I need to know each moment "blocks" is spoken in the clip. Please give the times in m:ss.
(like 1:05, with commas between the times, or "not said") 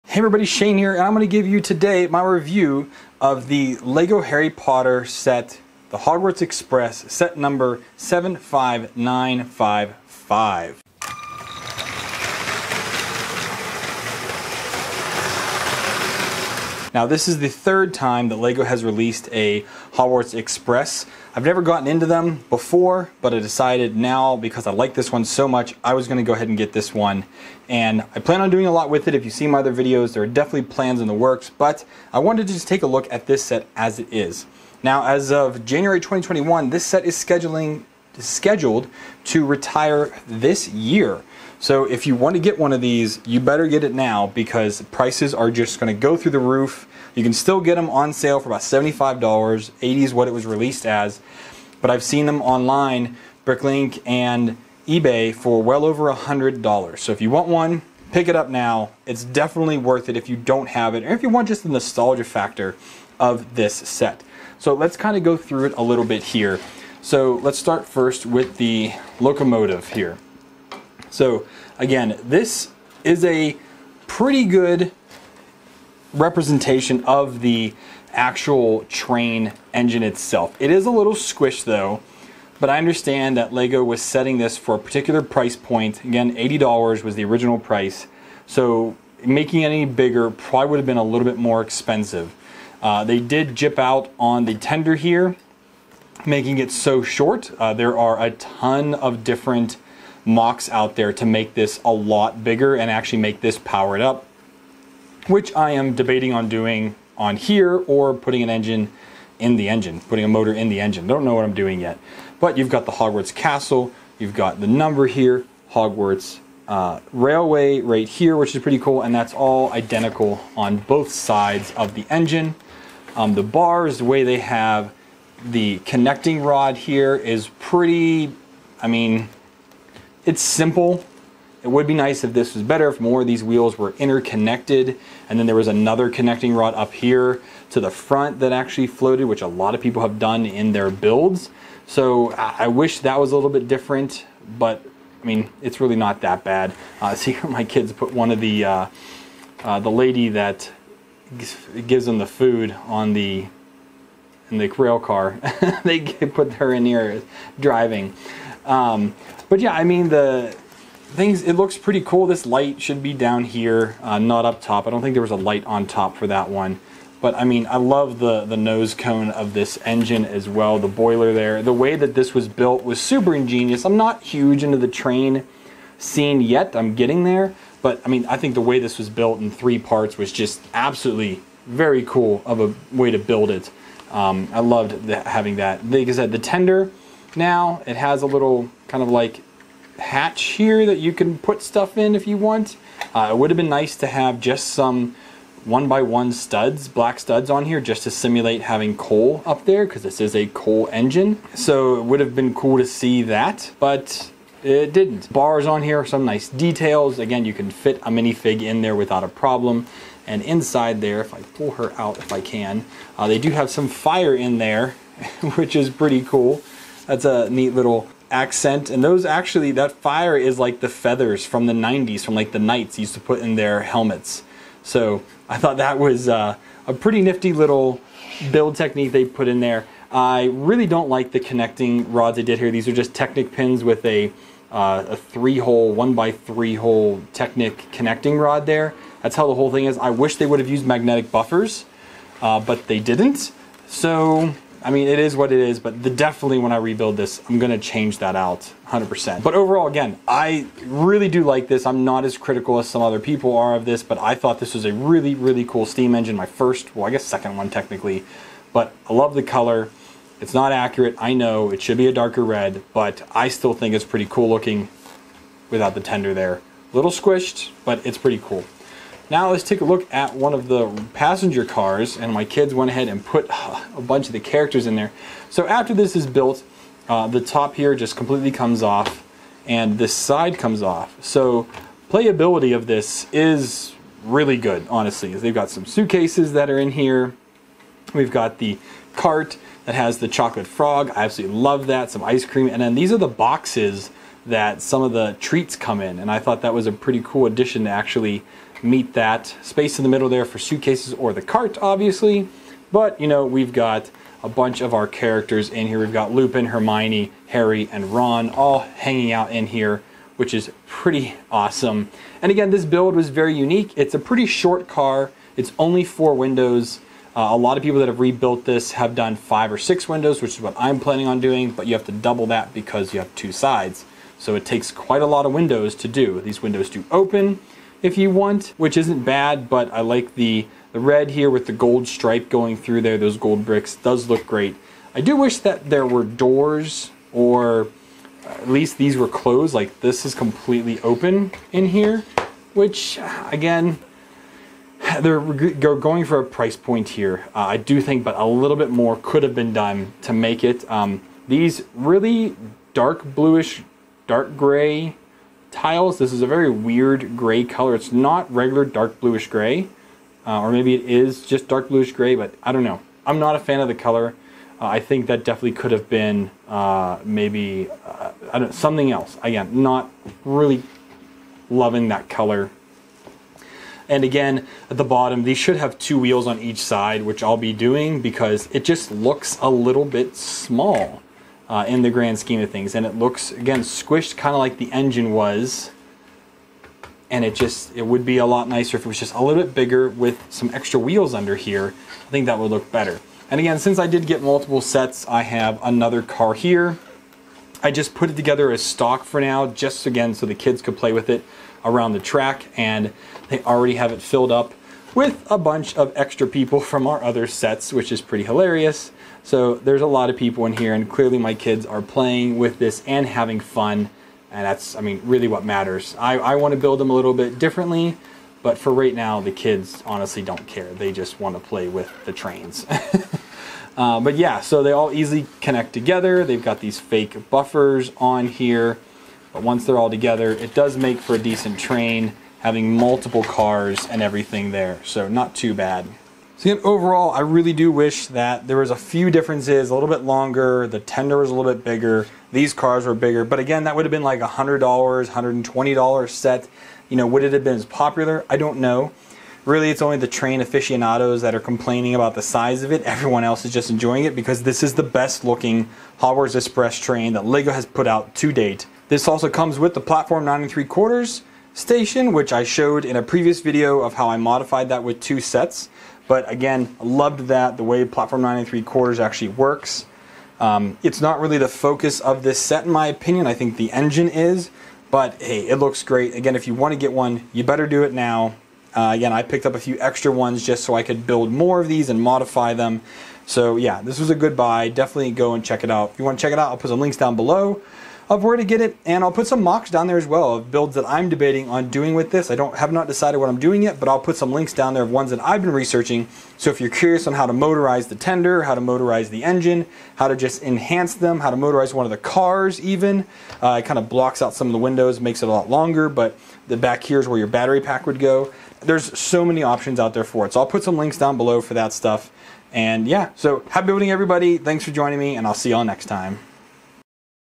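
8:24.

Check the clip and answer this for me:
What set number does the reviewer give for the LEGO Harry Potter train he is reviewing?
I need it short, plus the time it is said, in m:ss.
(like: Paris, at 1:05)
75955, at 0:07.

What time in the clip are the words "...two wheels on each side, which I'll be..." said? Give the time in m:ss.
6:15.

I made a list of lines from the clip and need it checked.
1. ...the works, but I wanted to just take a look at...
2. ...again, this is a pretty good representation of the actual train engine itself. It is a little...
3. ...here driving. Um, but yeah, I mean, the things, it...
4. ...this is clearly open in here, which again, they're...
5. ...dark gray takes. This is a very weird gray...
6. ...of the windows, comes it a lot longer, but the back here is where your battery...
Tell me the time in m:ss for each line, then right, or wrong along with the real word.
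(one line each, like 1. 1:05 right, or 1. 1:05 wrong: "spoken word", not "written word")
1. 0:31 right
2. 1:11 right
3. 2:36 right
4. 5:40 wrong: "completely", not "clearly"
5. 5:54 wrong: "tiles", not "takes"
6. 8:24 wrong: "makes", not "comes".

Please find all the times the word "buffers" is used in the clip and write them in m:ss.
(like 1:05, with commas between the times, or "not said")
4:01, 7:07.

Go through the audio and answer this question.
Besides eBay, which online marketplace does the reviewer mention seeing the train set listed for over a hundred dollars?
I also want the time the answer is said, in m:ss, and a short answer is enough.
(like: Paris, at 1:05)
Bricklink, at 0:53.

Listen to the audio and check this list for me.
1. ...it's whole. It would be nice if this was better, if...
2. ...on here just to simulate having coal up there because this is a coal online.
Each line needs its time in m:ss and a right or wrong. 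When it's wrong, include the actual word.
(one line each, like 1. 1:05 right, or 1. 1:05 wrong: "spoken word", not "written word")
1. 2:10 wrong: "simple", not "whole"
2. 3:17 wrong: "engine", not "online".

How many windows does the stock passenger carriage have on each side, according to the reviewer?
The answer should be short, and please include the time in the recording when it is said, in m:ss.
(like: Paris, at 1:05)
4, at 5:16.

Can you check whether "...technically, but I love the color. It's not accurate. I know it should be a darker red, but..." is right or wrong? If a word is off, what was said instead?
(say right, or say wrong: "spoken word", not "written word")
right.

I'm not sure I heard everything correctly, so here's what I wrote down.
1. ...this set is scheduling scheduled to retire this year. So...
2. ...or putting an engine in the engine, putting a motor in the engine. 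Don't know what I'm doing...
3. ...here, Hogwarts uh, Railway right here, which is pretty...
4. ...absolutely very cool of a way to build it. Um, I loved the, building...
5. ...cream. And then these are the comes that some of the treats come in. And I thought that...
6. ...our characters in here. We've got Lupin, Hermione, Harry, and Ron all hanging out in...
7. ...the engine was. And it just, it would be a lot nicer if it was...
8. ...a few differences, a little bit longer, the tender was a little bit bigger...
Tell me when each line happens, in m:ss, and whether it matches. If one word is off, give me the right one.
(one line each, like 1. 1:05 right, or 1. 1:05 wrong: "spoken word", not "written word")
1. 0:36 right
2. 1:47 right
3. 1:55 right
4. 3:00 wrong: "having", not "building"
5. 4:52 wrong: "boxes", not "comes"
6. 5:04 right
7. 6:24 right
8. 7:18 right.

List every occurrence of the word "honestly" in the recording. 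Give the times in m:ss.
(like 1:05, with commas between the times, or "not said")
4:44, 7:00.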